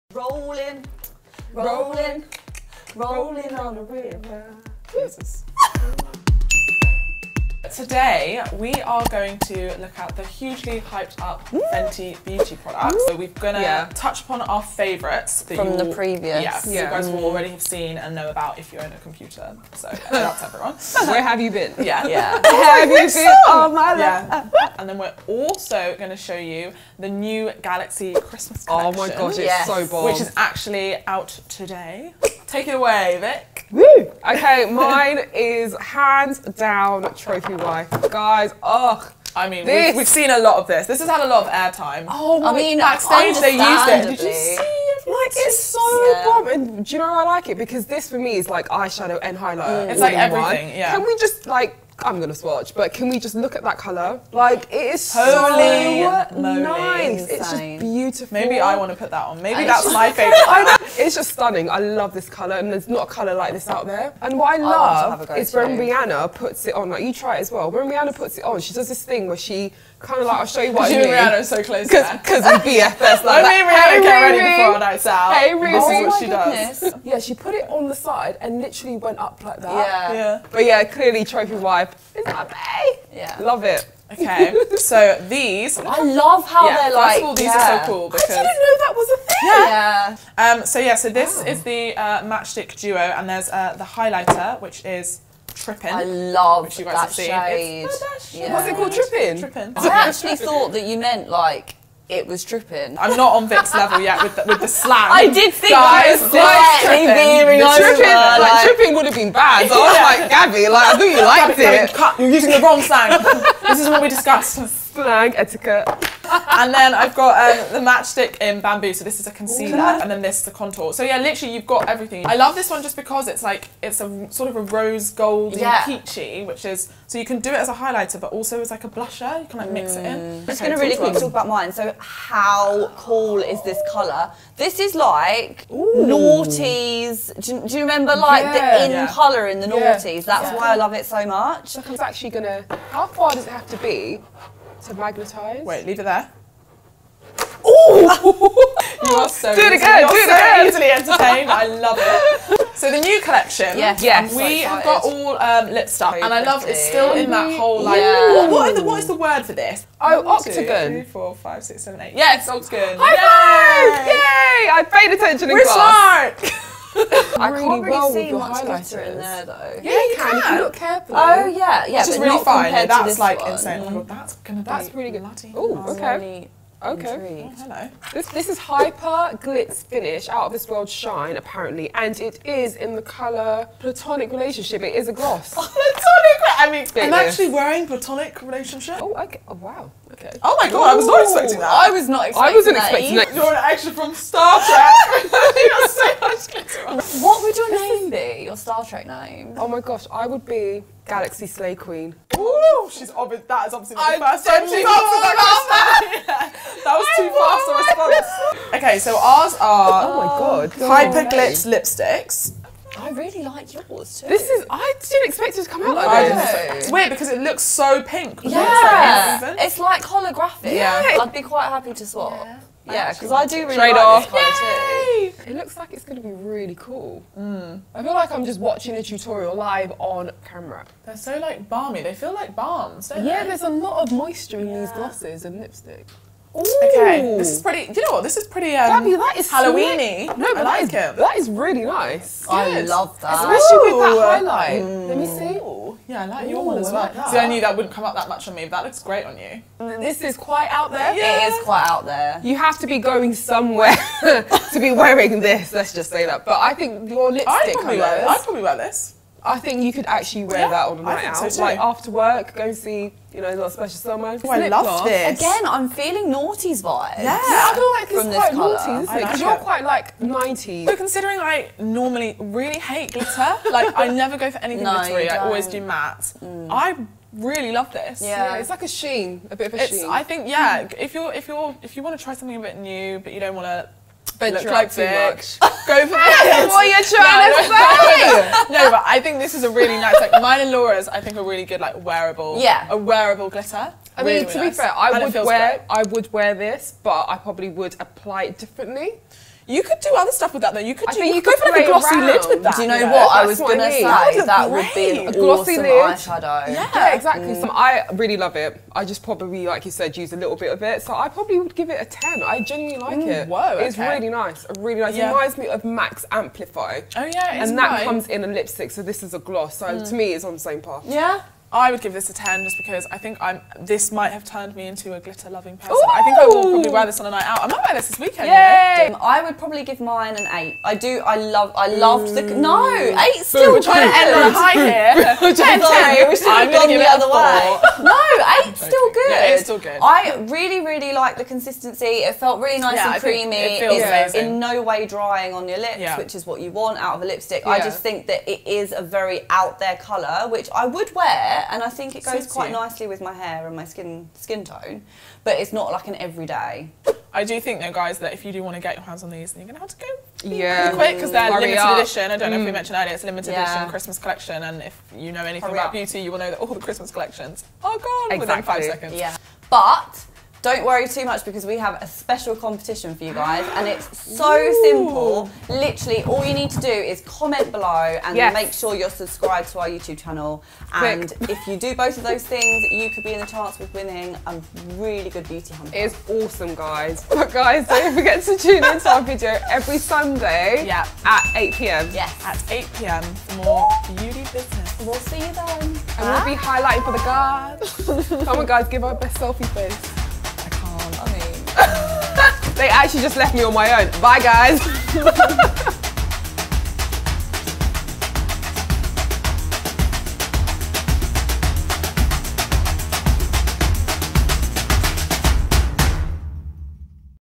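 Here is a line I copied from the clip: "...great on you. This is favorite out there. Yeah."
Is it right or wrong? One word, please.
wrong.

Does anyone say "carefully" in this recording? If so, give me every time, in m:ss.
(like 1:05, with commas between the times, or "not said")
2:50.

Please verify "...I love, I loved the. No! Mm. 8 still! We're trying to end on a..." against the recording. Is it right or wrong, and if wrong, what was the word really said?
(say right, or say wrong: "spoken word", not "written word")
right.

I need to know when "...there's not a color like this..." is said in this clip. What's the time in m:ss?
1:02.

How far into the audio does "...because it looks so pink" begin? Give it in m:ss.
3:37.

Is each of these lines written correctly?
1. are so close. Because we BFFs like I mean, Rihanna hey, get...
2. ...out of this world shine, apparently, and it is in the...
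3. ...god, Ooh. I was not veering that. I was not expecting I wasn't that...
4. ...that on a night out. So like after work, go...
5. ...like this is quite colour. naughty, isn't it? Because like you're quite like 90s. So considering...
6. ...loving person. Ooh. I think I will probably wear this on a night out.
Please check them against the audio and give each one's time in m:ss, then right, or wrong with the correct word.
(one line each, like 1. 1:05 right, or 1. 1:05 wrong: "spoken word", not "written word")
1. 1:11 right
2. 3:00 right
3. 3:10 wrong: "expecting", not "veering"
4. 4:20 right
5. 4:27 right
6. 5:25 right.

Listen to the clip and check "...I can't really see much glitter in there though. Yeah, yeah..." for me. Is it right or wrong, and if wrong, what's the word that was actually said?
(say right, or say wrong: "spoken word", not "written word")
right.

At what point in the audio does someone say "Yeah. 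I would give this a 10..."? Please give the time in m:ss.
5:21.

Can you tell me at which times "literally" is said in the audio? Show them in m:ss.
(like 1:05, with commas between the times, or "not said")
1:18, 2:01, 6:15.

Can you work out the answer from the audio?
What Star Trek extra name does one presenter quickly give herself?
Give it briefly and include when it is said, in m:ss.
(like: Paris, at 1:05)
Galaxy Slay Queen, at 3:21.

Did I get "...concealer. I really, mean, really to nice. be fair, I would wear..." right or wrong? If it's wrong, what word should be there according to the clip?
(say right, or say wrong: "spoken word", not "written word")
wrong: "glitter", not "concealer".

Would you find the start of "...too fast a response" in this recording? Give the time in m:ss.
3:27.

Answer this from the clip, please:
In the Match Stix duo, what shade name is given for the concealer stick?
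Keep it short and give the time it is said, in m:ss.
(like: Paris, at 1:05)
Bamboo, at 1:58.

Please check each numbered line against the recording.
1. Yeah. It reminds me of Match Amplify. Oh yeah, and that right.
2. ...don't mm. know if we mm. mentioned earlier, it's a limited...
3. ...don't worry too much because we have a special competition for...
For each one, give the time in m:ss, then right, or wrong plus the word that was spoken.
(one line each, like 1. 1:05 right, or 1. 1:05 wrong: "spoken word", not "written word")
1. 5:15 wrong: "Max", not "Match"
2. 6:02 right
3. 6:10 right.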